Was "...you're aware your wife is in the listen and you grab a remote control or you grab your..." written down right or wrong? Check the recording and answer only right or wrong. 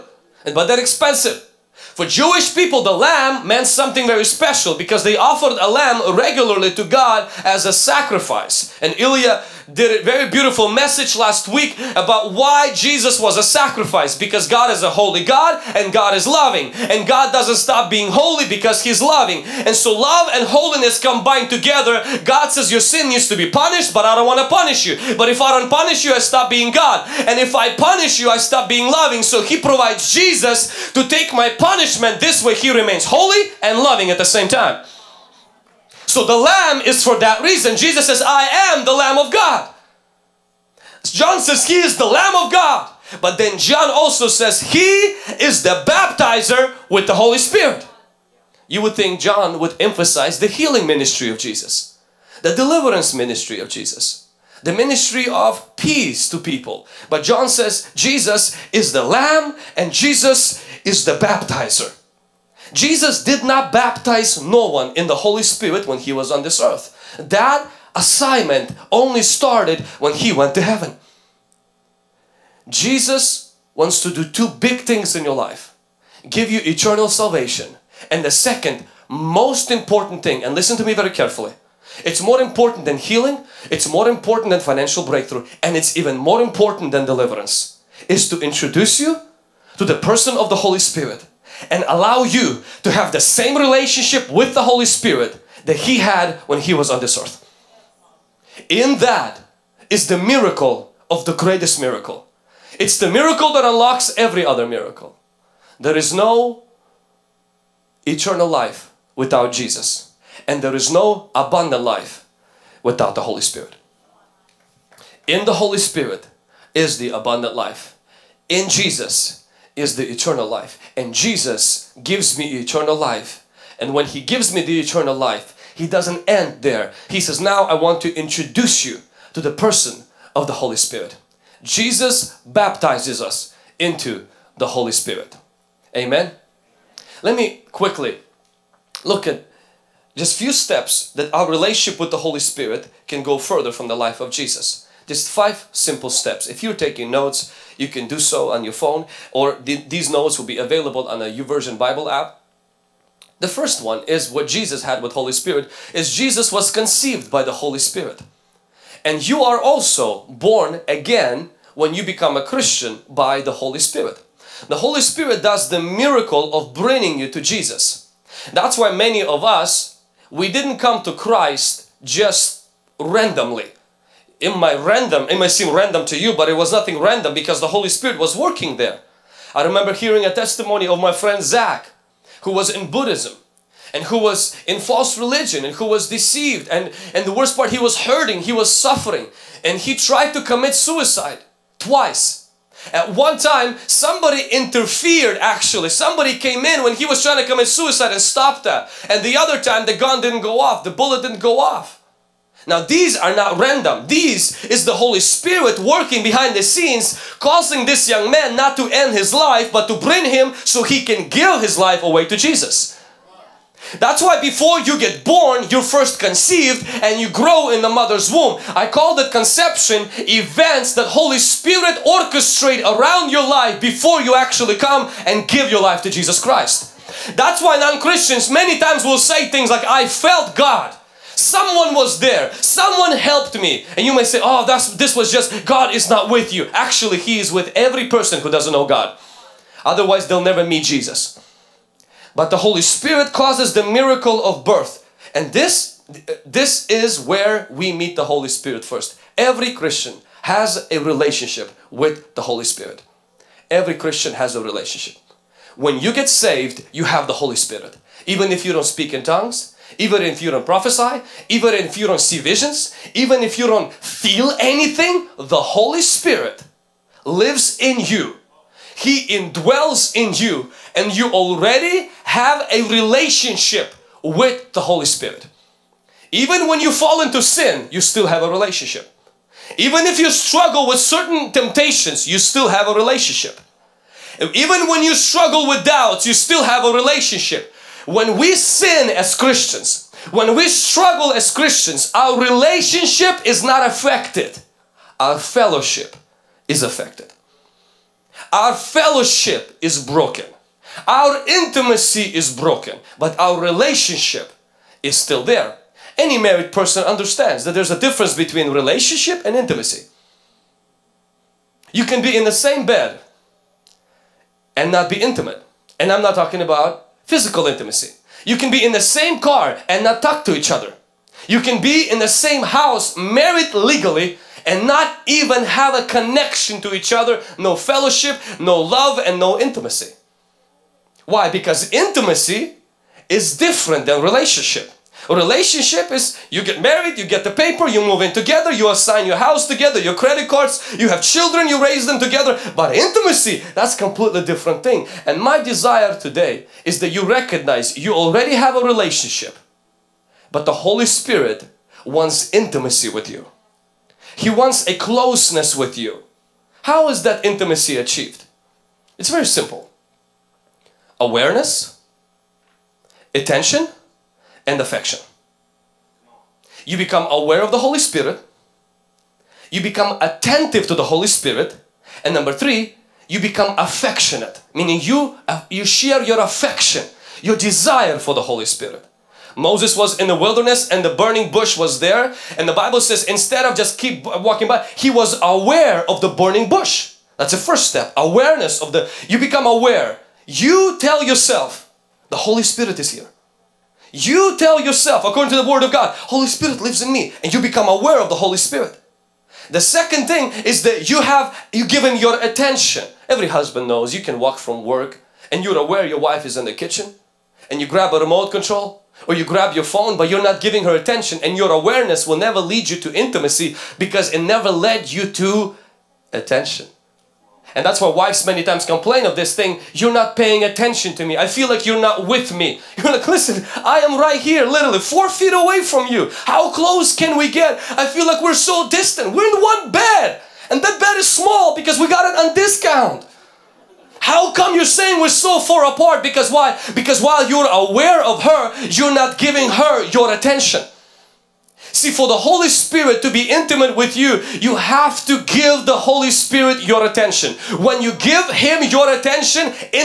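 wrong.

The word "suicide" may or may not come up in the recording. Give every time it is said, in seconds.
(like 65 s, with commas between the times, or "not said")
190 s, 197 s.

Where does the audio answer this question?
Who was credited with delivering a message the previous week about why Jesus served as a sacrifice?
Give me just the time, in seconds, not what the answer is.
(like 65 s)
8 s.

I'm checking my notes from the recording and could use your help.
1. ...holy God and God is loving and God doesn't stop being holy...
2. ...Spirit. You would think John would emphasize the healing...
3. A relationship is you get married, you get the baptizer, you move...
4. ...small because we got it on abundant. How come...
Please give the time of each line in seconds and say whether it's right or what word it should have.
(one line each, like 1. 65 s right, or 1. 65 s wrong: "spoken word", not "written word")
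1. 14 s right
2. 47 s right
3. 335 s wrong: "paper", not "baptizer"
4. 431 s wrong: "discount", not "abundant".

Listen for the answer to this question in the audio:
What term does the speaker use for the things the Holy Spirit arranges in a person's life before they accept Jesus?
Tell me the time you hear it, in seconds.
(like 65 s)
219 s.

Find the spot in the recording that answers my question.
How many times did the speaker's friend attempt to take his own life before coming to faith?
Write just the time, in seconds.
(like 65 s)
191 s.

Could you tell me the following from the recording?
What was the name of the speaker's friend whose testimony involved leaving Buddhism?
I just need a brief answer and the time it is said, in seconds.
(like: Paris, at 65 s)
Zach, at 181 s.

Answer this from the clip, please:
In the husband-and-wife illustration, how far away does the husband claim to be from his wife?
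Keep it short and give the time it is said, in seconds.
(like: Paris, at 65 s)
4 feet, at 424 s.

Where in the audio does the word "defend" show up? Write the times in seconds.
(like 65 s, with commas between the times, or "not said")
not said.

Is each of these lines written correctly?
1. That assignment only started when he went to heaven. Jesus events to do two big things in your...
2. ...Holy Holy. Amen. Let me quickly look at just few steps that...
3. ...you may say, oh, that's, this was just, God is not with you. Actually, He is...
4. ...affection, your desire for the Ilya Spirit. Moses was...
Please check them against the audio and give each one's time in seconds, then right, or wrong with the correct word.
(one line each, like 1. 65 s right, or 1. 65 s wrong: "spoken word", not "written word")
1. 67 s wrong: "wants", not "events"
2. 134 s wrong: "Spirit", not "Holy"
3. 234 s right
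4. 376 s wrong: "Holy", not "Ilya".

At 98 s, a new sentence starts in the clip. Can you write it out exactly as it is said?
In that is the miracle of the greatest miracle.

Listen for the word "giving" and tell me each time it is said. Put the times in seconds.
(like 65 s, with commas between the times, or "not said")
410 s, 439 s.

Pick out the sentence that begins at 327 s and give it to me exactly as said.
No fellowship, no love, and no intimacy.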